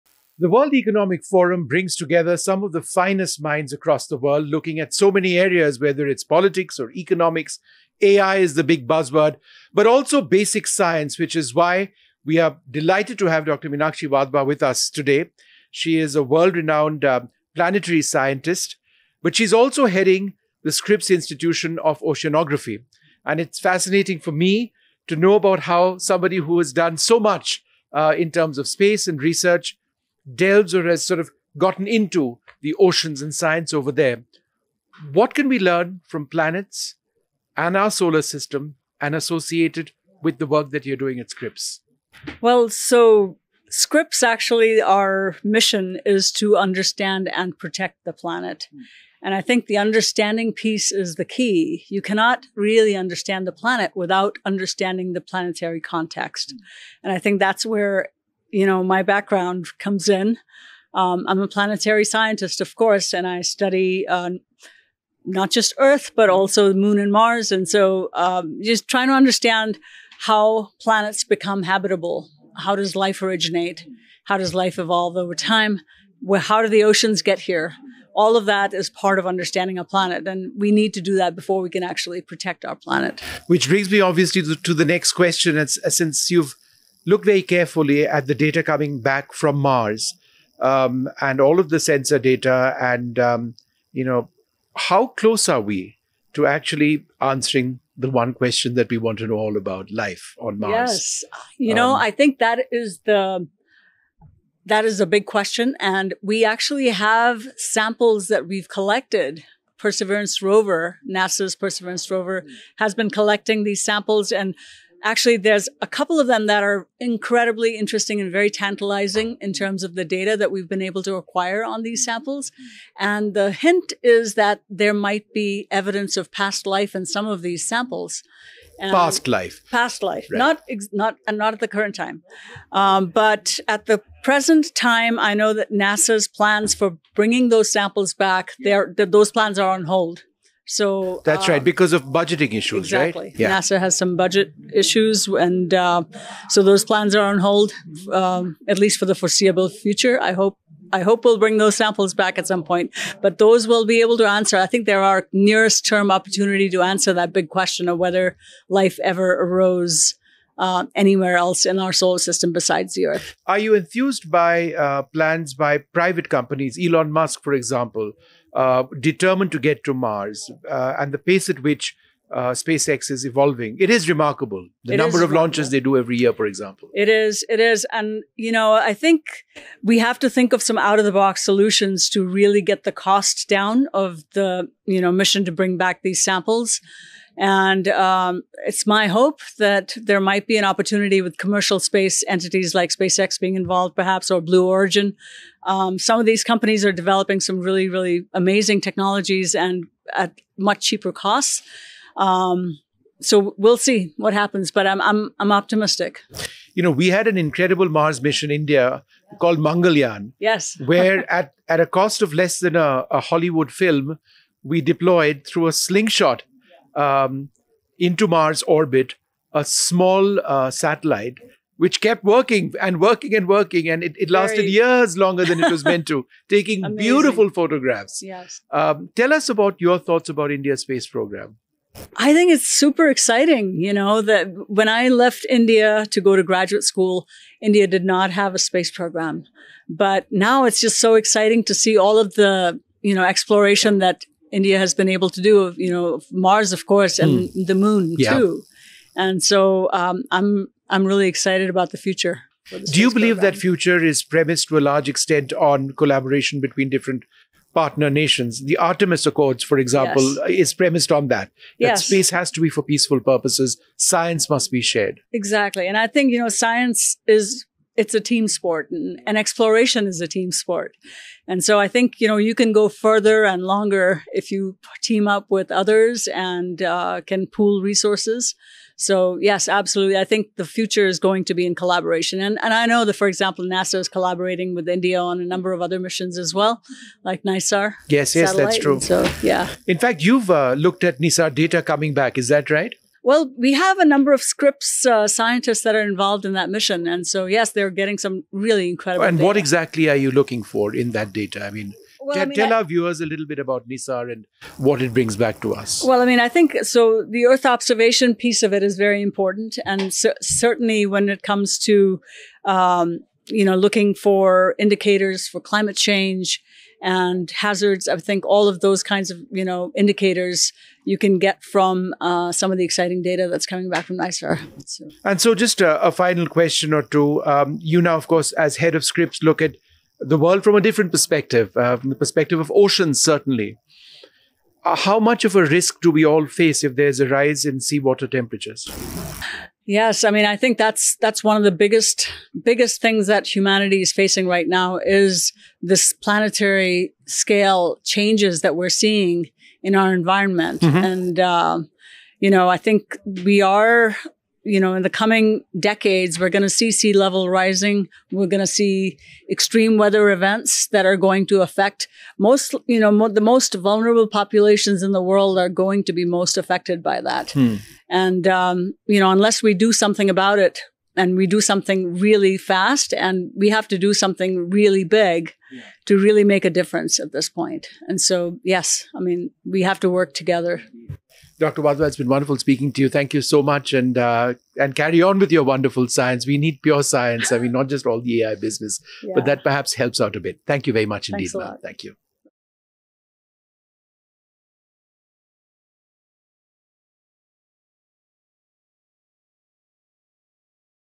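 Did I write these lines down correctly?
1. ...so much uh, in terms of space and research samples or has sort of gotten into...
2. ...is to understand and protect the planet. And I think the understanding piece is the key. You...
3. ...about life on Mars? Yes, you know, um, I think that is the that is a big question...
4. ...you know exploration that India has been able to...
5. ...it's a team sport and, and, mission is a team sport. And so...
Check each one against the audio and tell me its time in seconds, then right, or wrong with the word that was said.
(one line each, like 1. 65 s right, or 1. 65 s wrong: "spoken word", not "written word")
1. 26 s wrong: "delves", not "samples"
2. 46 s right
3. 99 s right
4. 243 s right
5. 267 s wrong: "exploration", not "mission".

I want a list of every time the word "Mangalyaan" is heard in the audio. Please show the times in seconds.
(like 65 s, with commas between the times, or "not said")
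209 s.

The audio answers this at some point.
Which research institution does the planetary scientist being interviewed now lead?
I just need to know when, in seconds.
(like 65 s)
20 s.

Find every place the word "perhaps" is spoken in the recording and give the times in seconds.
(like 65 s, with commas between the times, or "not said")
193 s, 389 s.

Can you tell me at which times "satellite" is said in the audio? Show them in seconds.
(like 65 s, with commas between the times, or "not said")
220 s, 288 s.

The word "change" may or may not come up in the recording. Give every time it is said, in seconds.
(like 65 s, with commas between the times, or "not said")
315 s, 348 s.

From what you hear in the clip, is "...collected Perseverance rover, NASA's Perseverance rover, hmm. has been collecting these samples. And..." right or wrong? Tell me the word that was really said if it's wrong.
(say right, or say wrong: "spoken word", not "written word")
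right.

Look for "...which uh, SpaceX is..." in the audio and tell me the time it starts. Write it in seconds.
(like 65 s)
171 s.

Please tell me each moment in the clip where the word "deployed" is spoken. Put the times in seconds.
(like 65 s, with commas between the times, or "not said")
214 s.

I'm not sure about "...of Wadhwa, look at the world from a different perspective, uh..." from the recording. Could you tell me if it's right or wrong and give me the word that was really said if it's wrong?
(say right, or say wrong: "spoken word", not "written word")
wrong: "Scripps", not "Wadhwa".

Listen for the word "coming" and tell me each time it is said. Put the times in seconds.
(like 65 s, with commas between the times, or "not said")
88 s, 291 s, 323 s, 355 s.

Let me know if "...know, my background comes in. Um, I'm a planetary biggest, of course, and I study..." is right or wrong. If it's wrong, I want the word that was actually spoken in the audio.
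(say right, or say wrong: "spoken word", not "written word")
wrong: "scientist", not "biggest".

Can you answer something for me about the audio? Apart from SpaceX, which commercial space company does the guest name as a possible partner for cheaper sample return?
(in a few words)
Blue Origin.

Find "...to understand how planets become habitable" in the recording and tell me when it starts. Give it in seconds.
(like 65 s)
69 s.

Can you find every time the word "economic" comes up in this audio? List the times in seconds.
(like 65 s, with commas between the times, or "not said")
0 s, 6 s.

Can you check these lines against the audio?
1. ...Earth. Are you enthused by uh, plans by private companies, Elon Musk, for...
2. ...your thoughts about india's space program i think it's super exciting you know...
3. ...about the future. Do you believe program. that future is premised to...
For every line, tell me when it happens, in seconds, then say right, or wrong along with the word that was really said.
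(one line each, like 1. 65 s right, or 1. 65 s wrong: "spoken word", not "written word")
1. 163 s right
2. 229 s right
3. 251 s right.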